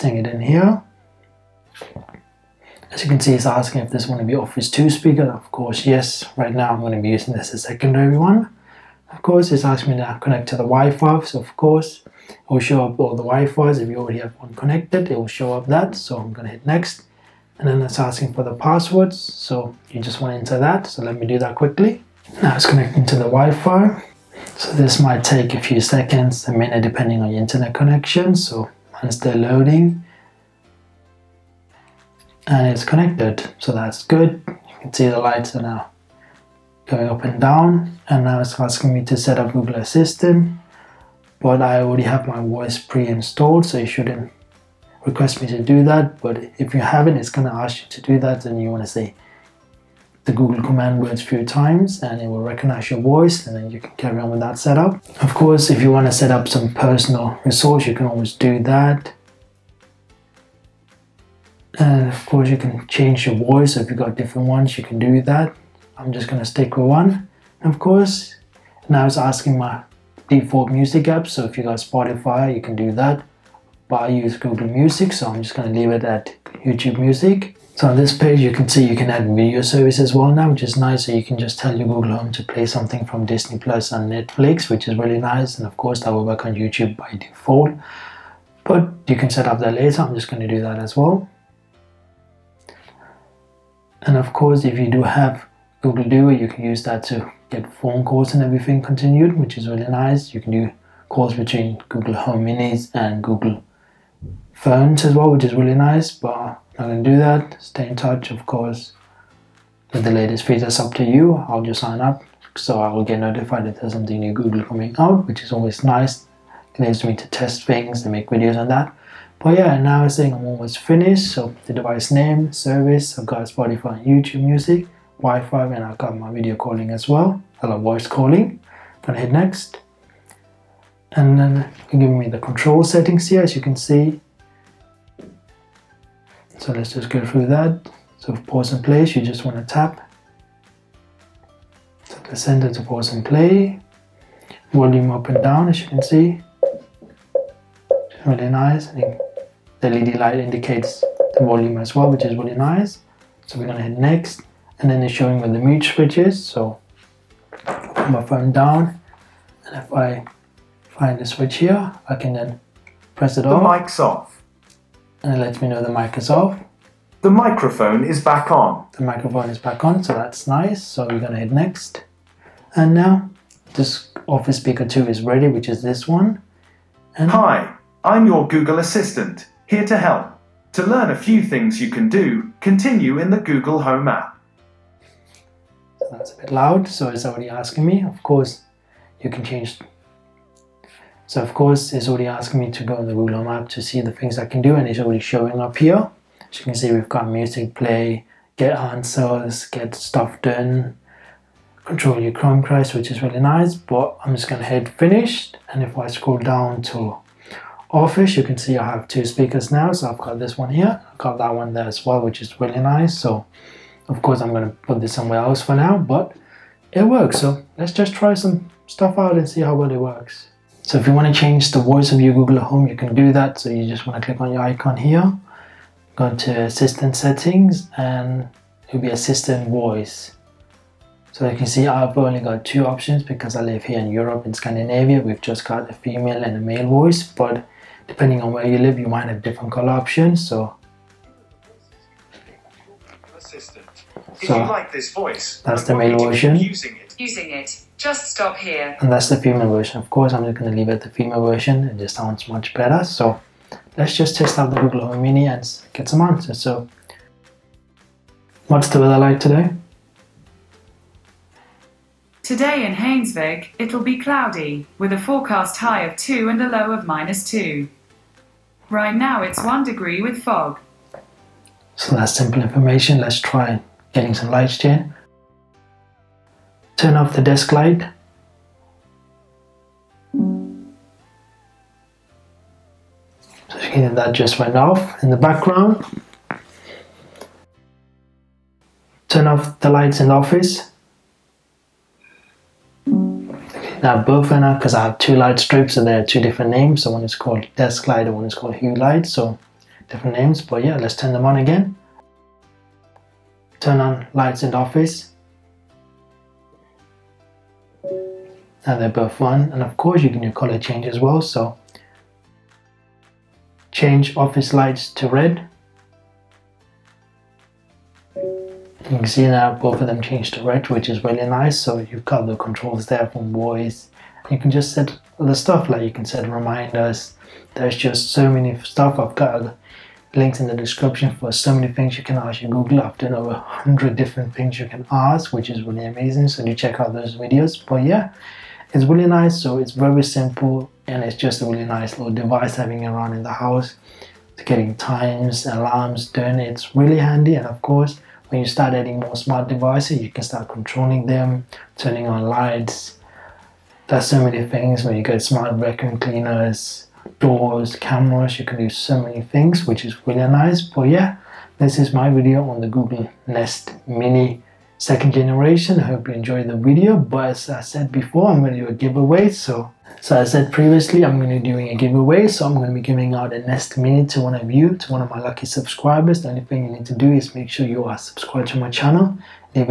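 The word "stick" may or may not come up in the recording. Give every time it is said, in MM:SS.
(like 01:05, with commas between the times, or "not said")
01:06.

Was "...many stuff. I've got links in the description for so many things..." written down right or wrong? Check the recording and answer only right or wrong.
right.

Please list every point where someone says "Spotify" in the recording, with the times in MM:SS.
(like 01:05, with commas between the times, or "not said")
01:11, 02:03.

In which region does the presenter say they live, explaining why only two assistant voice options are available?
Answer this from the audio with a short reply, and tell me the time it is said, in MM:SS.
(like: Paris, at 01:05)
Scandinavia, at 03:54.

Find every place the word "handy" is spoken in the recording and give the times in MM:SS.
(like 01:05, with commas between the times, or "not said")
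05:47.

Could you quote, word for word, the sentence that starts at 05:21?
So you've got the controls there from voice.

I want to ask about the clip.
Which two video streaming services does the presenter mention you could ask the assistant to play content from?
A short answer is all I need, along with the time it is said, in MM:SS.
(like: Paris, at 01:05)
Disney Plus and Netflix, at 01:23.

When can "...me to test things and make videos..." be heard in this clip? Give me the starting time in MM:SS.
01:57.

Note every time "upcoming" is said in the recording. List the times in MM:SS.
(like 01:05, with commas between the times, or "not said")
not said.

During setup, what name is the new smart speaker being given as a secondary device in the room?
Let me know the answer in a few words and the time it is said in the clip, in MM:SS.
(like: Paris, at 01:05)
Office 2 speaker, at 00:04.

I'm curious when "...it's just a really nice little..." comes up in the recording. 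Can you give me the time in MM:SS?
05:41.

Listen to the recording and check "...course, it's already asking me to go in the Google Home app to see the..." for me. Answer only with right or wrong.
right.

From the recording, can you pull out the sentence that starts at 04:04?
If so you like this voice, that's the male version.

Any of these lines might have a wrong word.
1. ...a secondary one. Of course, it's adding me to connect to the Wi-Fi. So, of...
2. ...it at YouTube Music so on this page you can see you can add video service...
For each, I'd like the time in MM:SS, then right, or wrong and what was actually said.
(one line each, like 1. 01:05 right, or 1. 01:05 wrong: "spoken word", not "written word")
1. 00:07 wrong: "asking", not "adding"
2. 01:15 right.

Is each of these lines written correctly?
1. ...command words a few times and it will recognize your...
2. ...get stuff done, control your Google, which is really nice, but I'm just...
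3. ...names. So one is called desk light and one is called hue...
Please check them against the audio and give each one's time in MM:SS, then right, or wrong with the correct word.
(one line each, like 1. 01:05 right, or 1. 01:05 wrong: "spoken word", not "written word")
1. 00:50 right
2. 03:19 wrong: "Chromecast", not "Google"
3. 04:56 right.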